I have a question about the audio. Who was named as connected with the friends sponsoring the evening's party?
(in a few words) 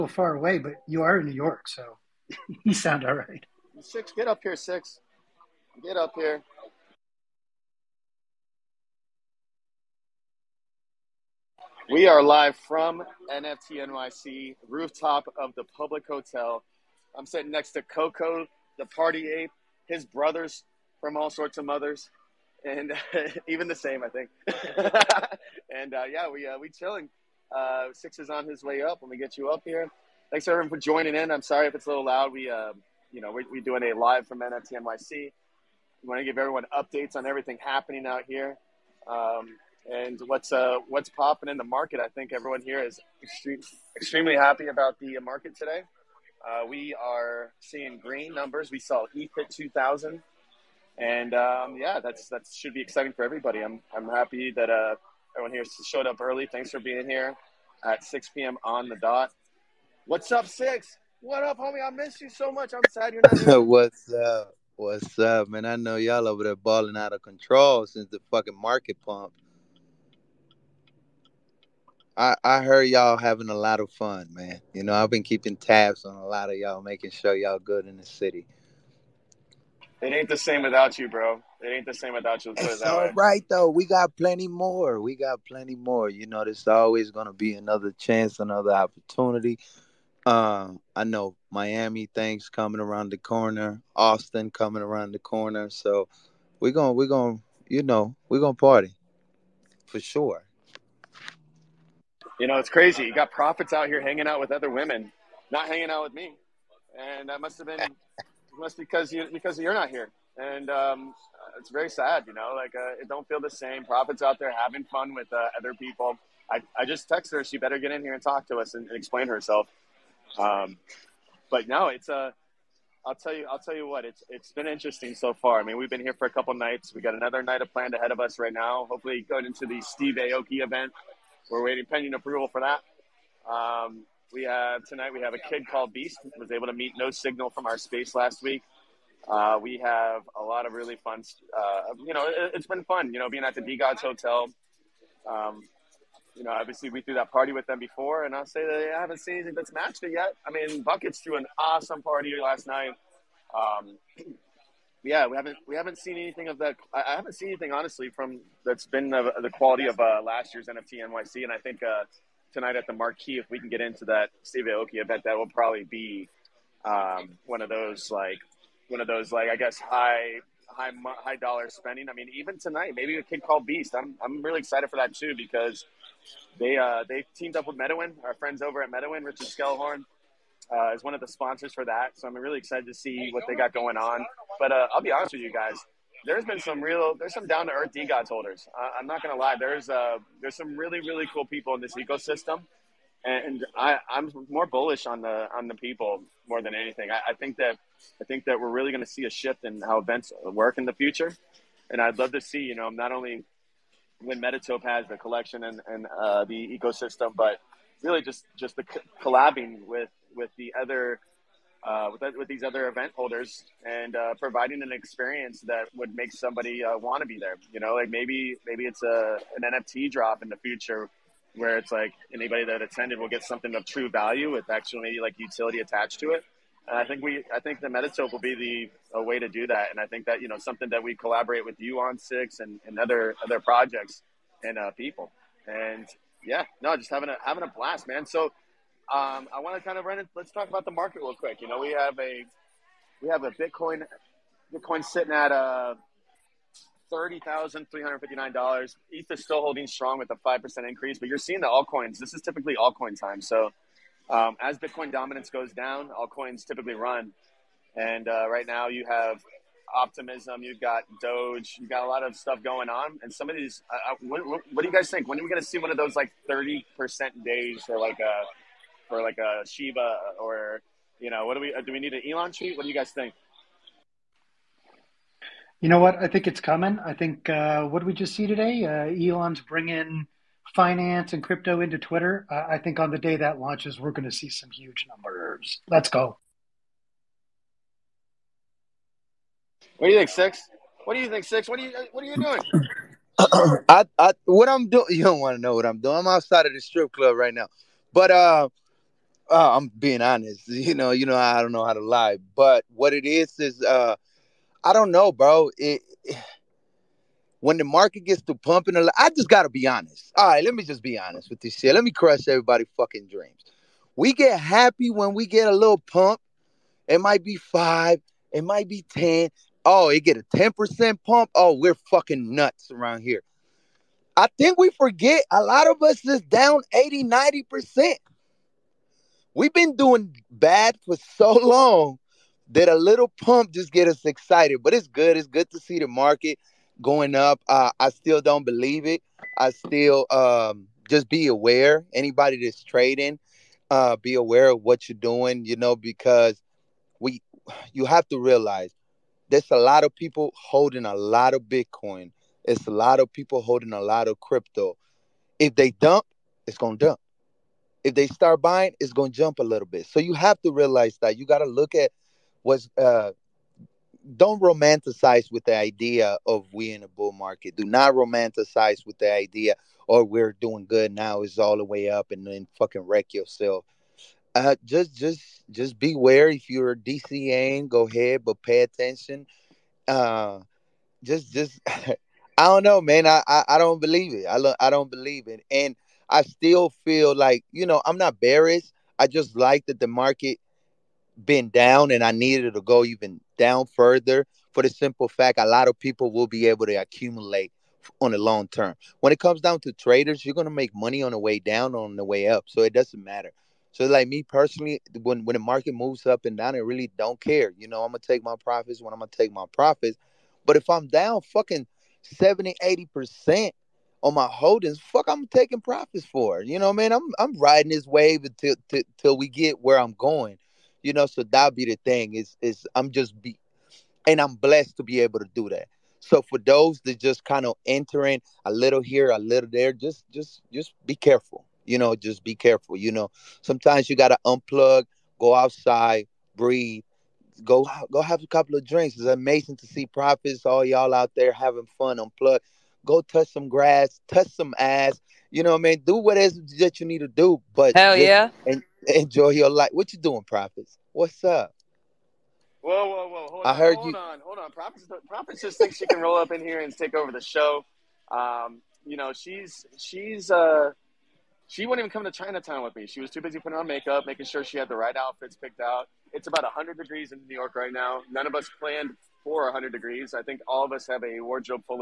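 Richard Skelhorn.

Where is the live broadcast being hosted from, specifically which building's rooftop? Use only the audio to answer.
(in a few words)
Public Hotel.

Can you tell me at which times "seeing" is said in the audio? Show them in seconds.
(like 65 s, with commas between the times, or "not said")
47 s, 251 s.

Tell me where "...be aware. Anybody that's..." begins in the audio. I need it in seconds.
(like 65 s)
341 s.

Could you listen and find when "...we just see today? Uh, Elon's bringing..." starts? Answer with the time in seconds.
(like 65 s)
278 s.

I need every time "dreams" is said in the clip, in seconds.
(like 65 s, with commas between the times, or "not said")
313 s.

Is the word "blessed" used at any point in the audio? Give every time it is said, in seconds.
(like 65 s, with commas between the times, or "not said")
424 s.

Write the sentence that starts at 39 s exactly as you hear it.
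Um, and what's uh, what's popping in the market.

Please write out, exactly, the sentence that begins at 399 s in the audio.
When it comes down to traders, you're gonna make money on the way down, on the way up.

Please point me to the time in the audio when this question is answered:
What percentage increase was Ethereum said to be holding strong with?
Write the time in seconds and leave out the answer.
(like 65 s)
250 s.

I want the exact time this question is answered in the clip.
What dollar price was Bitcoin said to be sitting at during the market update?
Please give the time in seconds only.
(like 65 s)
247 s.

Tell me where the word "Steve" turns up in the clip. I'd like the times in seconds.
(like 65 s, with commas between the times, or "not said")
129 s, 164 s.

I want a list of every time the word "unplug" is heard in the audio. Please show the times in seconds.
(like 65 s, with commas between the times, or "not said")
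434 s, 442 s.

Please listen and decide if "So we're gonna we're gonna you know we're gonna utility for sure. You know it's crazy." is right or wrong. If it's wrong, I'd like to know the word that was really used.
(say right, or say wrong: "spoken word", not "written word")
wrong: "party", not "utility".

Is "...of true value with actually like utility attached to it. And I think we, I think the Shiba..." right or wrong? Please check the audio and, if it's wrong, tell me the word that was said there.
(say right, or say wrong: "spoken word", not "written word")
wrong: "Metatope", not "Shiba".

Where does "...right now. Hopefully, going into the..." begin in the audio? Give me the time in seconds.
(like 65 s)
128 s.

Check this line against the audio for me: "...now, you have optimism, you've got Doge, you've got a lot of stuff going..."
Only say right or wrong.
right.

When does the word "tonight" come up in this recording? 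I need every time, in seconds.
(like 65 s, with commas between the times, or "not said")
134 s, 162 s, 172 s.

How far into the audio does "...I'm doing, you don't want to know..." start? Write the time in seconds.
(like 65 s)
294 s.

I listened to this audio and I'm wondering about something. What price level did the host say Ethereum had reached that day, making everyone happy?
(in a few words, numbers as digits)
2,000.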